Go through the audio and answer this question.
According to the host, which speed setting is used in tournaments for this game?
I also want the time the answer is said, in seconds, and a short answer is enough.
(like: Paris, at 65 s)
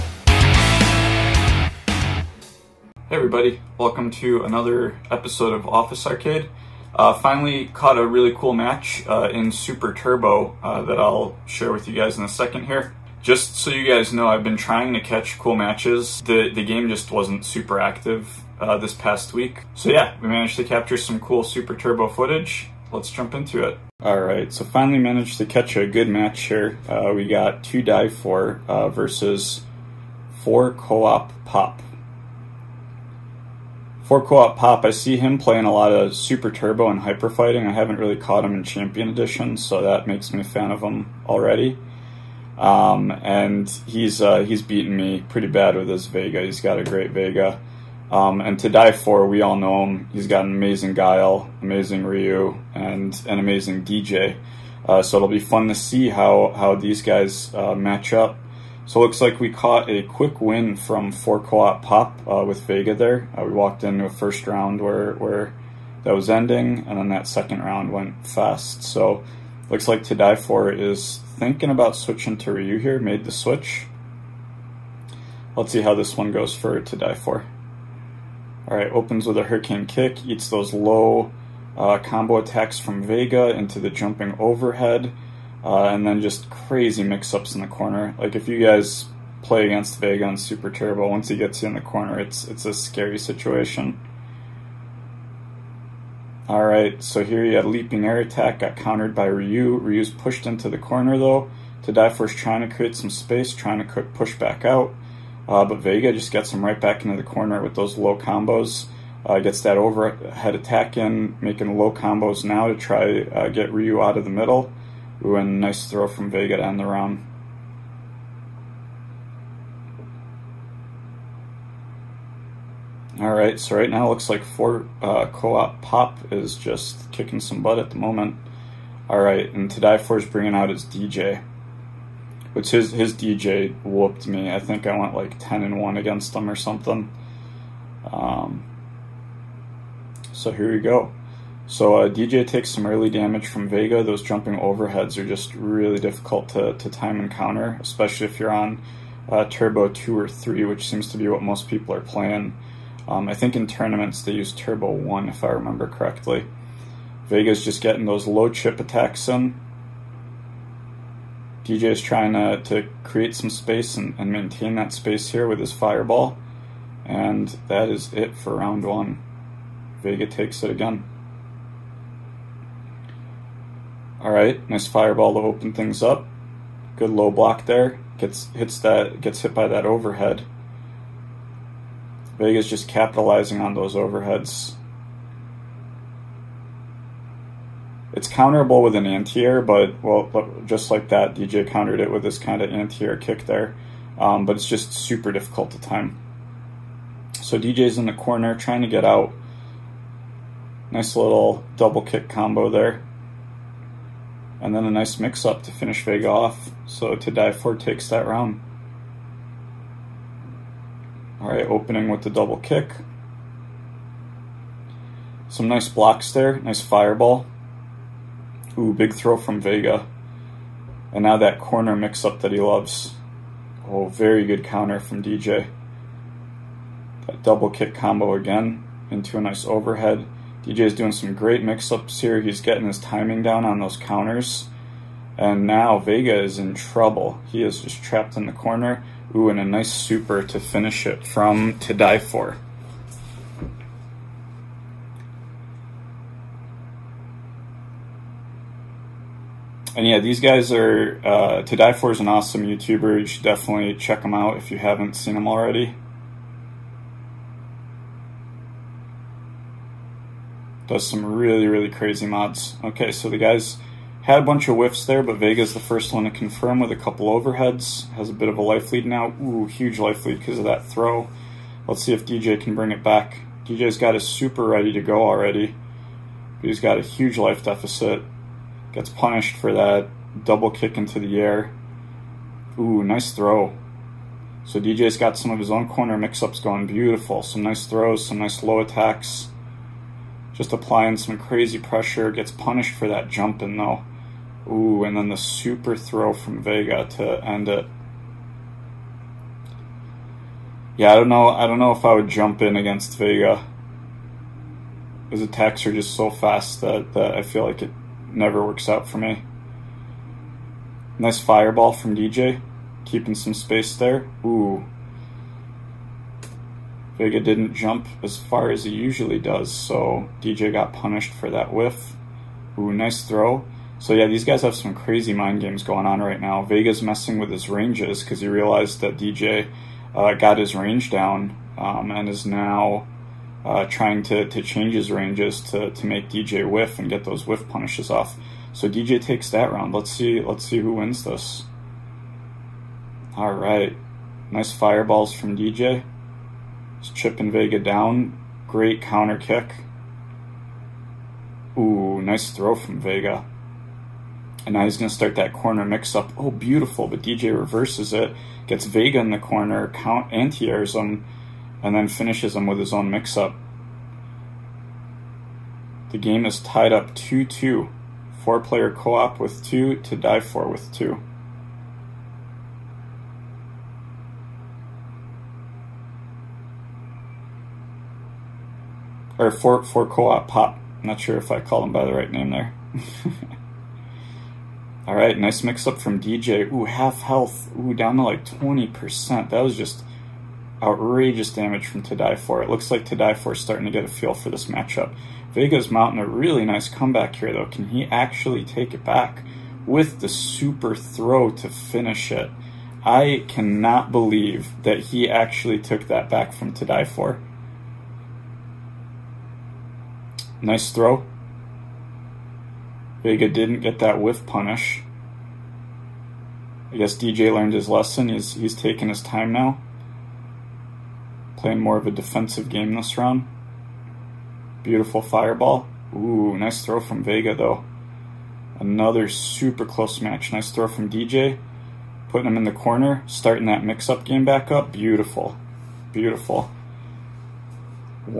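Turbo 1, at 154 s.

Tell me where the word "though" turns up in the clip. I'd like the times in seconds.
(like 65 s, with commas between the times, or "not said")
101 s, 293 s, 397 s, 427 s.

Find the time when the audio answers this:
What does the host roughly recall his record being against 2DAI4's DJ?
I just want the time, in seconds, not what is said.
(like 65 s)
135 s.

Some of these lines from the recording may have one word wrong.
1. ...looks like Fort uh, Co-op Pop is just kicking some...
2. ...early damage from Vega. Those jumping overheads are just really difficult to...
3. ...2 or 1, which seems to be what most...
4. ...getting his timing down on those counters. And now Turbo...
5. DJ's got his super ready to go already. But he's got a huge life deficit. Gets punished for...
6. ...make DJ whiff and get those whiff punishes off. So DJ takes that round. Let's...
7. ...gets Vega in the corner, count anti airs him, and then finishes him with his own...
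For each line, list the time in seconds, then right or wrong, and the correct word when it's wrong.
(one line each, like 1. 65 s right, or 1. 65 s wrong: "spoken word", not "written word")
1. 124 s right
2. 142 s right
3. 149 s wrong: "3", not "1"
4. 232 s wrong: "Vega", not "Turbo"
5. 273 s right
6. 336 s right
7. 358 s right.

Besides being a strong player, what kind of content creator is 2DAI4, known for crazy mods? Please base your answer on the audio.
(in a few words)
YouTuber.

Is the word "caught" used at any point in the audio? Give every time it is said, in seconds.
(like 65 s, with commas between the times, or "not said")
7 s, 38 s, 59 s.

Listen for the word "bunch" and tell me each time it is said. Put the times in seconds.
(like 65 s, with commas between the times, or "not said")
264 s.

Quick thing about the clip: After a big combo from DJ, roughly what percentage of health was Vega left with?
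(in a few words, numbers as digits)
20%.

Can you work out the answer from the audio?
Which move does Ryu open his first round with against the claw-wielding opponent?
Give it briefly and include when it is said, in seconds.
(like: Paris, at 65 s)
hurricane kick, at 79 s.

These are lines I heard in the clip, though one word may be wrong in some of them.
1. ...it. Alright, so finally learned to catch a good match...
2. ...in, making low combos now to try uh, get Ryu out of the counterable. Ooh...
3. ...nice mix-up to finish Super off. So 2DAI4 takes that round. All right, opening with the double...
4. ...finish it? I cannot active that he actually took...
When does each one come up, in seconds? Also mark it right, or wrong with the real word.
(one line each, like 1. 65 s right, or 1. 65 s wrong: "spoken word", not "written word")
1. 23 s wrong: "managed", not "learned"
2. 110 s wrong: "middle", not "counterable"
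3. 204 s wrong: "Vega", not "Super"
4. 401 s wrong: "believe", not "active".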